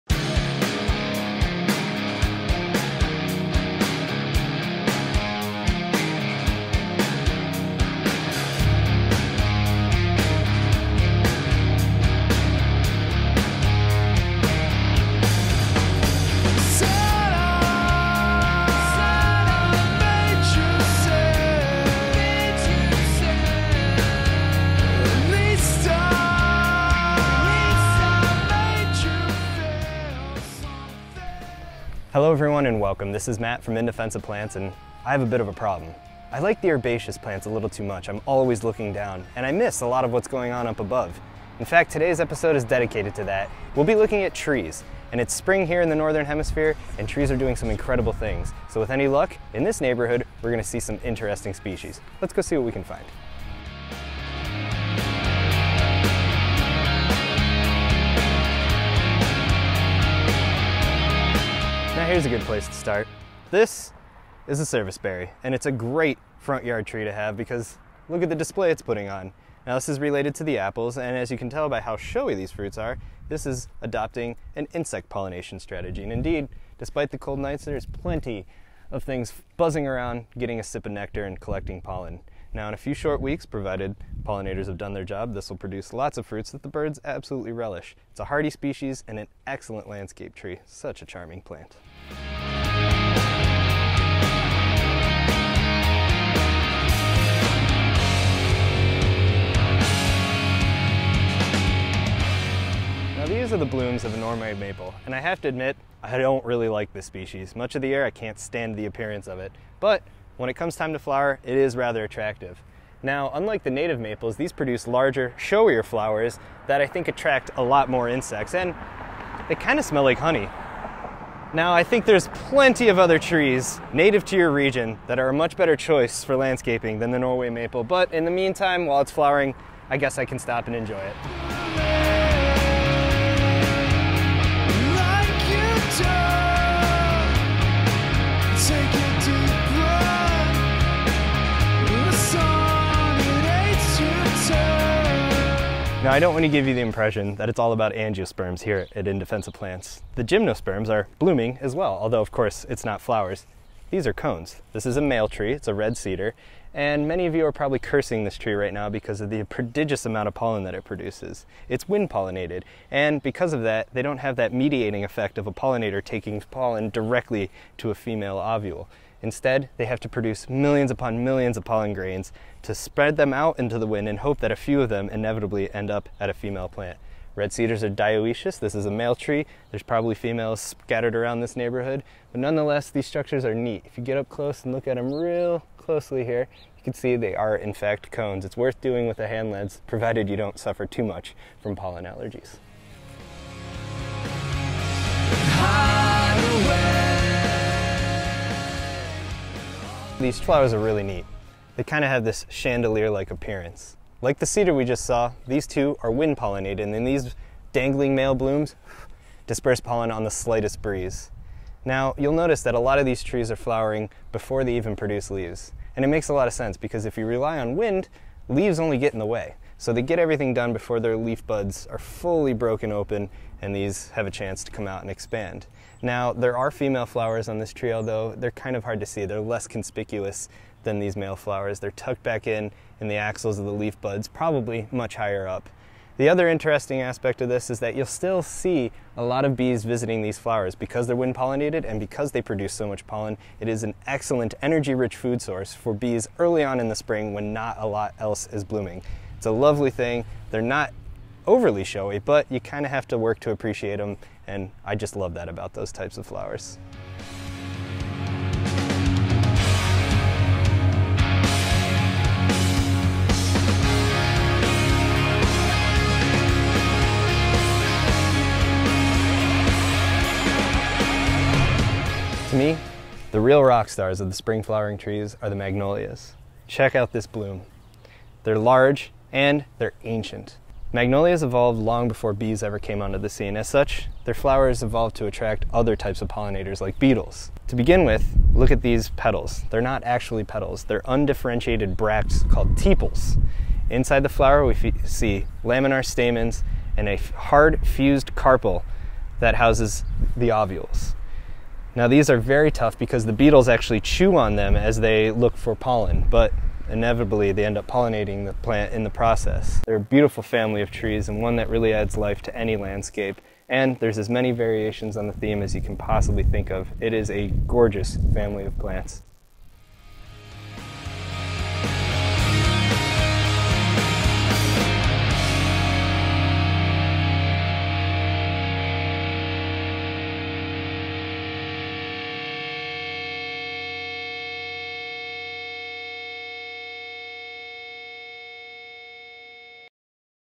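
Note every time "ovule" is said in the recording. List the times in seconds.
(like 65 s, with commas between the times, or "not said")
168 s, 300 s.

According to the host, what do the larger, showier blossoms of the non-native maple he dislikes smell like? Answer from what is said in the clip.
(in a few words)
Honey.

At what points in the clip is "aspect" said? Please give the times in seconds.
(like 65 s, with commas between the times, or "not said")
237 s.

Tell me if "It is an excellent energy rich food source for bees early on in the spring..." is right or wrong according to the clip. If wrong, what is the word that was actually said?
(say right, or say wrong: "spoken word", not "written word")
right.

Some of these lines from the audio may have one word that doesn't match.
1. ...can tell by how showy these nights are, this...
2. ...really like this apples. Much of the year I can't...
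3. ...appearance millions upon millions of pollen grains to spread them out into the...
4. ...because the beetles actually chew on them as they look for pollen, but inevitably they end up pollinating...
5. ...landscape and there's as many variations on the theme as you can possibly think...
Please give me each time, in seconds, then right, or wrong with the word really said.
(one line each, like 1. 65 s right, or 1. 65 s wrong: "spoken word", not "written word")
1. 71 s wrong: "fruits", not "nights"
2. 106 s wrong: "species", not "apples"
3. 170 s wrong: "produce", not "appearance"
4. 302 s right
5. 312 s right.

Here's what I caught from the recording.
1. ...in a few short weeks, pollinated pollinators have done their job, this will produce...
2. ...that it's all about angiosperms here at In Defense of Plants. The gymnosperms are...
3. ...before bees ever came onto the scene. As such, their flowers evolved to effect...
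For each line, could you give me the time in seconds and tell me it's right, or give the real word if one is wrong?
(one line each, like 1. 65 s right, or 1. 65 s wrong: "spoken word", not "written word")
1. 82 s wrong: "provided", not "pollinated"
2. 147 s right
3. 282 s wrong: "attract", not "effect".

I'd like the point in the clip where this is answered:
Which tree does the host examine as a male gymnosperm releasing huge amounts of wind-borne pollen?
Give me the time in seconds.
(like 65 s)
155 s.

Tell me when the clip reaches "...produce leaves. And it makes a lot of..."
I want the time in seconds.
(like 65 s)
214 s.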